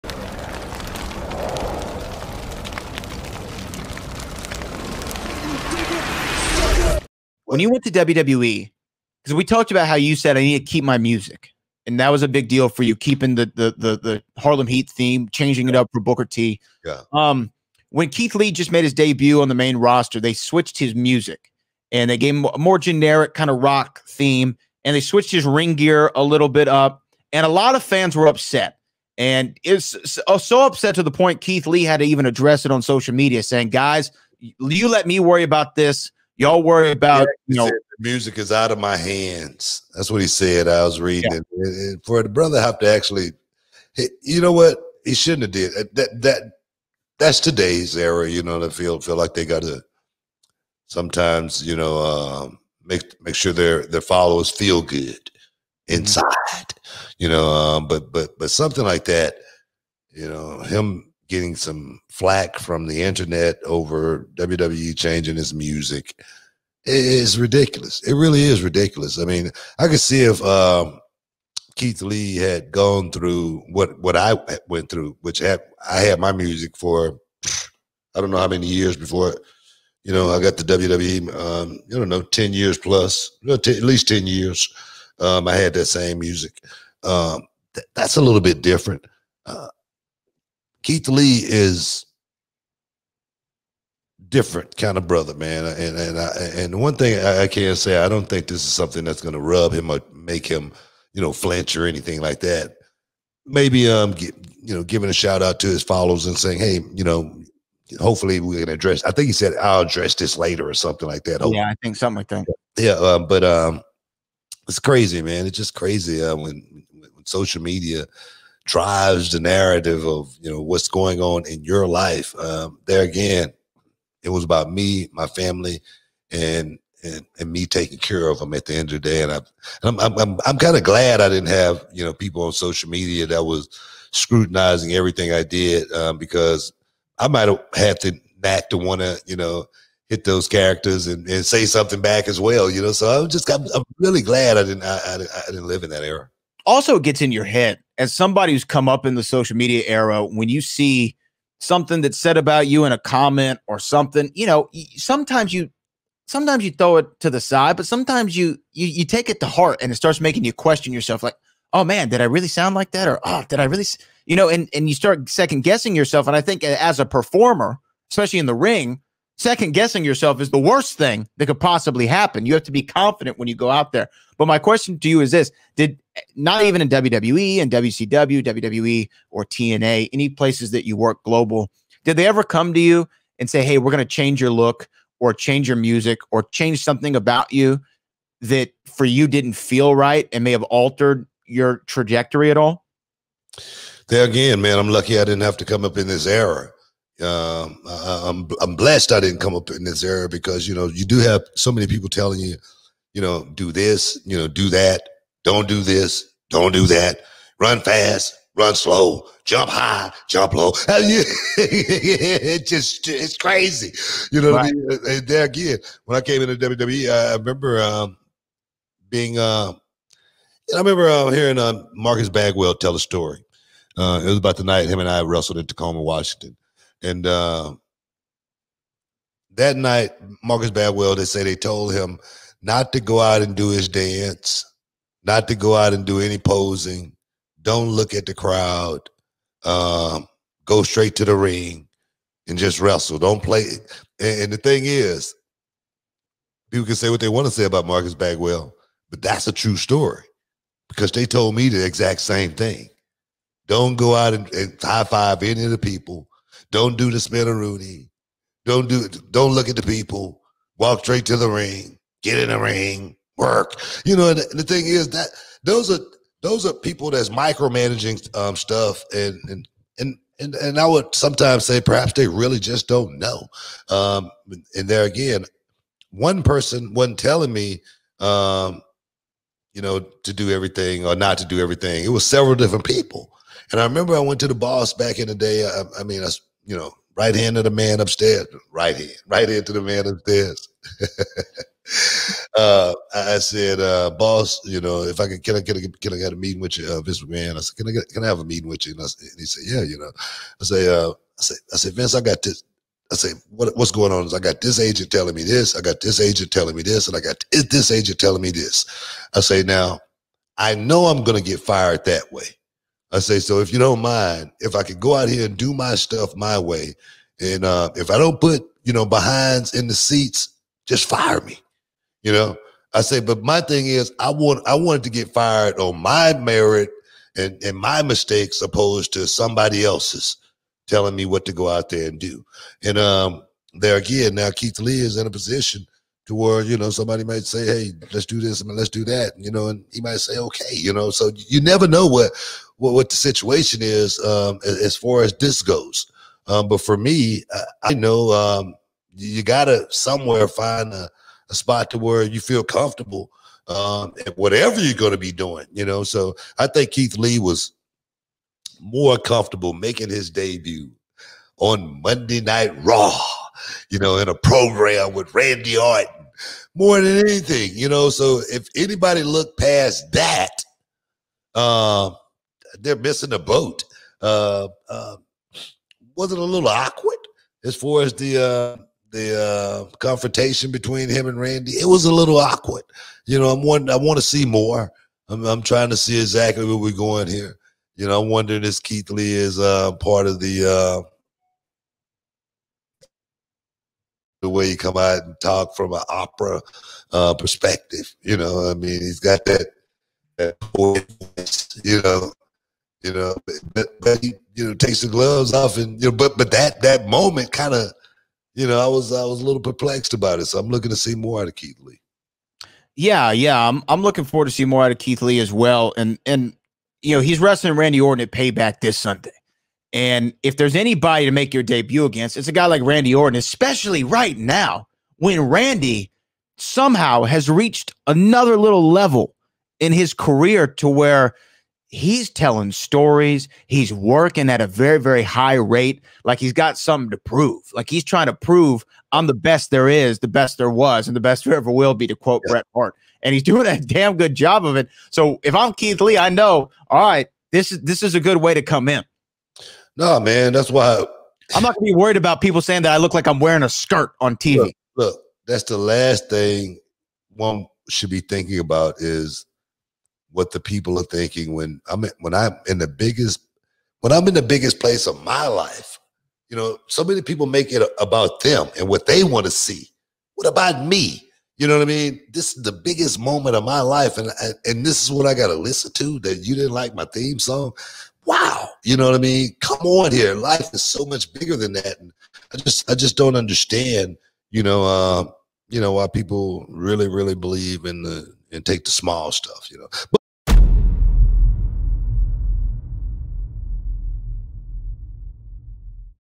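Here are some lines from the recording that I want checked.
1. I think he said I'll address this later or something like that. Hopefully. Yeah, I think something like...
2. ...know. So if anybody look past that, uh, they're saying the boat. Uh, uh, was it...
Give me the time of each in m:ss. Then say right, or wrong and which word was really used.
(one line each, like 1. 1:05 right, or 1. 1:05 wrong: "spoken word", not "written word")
1. 1:49 right
2. 6:07 wrong: "missing", not "saying".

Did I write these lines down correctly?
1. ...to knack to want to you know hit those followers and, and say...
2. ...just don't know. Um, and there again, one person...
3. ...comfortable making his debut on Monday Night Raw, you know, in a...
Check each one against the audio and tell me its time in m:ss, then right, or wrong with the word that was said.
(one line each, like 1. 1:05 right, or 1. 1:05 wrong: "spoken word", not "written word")
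1. 2:18 wrong: "characters", not "followers"
2. 4:32 right
3. 5:59 right.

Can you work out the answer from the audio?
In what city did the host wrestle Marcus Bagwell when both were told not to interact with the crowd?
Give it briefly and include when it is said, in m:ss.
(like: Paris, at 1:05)
Tacoma, Washington, at 3:45.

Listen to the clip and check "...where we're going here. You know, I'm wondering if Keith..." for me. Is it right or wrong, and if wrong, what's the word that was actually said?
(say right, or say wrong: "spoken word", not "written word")
right.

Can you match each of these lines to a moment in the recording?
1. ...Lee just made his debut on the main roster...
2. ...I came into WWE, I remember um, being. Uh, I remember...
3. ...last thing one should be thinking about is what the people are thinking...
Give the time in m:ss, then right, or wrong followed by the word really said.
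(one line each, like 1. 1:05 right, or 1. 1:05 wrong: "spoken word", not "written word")
1. 0:18 right
2. 3:36 right
3. 7:35 right.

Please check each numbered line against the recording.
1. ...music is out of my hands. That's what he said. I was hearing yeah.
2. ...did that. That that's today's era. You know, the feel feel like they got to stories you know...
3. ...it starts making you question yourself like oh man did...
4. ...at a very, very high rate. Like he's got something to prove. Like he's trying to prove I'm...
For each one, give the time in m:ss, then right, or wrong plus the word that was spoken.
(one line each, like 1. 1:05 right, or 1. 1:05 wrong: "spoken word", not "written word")
1. 0:37 wrong: "reading", not "hearing"
2. 0:45 wrong: "sometimes", not "stories"
3. 2:39 right
4. 7:14 right.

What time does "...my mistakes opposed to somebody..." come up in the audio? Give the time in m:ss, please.
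5:27.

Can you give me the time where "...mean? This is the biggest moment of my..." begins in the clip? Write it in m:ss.
7:51.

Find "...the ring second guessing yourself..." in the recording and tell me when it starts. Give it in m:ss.
2:48.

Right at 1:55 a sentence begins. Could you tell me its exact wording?
It's just crazy uh, when, when social media drives the narrative of you know what's going on in your life.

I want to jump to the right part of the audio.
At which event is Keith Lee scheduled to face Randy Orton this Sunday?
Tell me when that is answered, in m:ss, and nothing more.
6:58.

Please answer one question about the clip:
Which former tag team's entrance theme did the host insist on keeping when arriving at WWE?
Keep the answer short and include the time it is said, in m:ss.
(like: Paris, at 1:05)
Harlem Heat, at 0:14.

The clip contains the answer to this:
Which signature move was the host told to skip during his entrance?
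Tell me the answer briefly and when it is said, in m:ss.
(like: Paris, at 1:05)
Spinaroonie, at 4:17.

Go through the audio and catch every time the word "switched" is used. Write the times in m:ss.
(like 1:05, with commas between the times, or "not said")
0:20, 0:25.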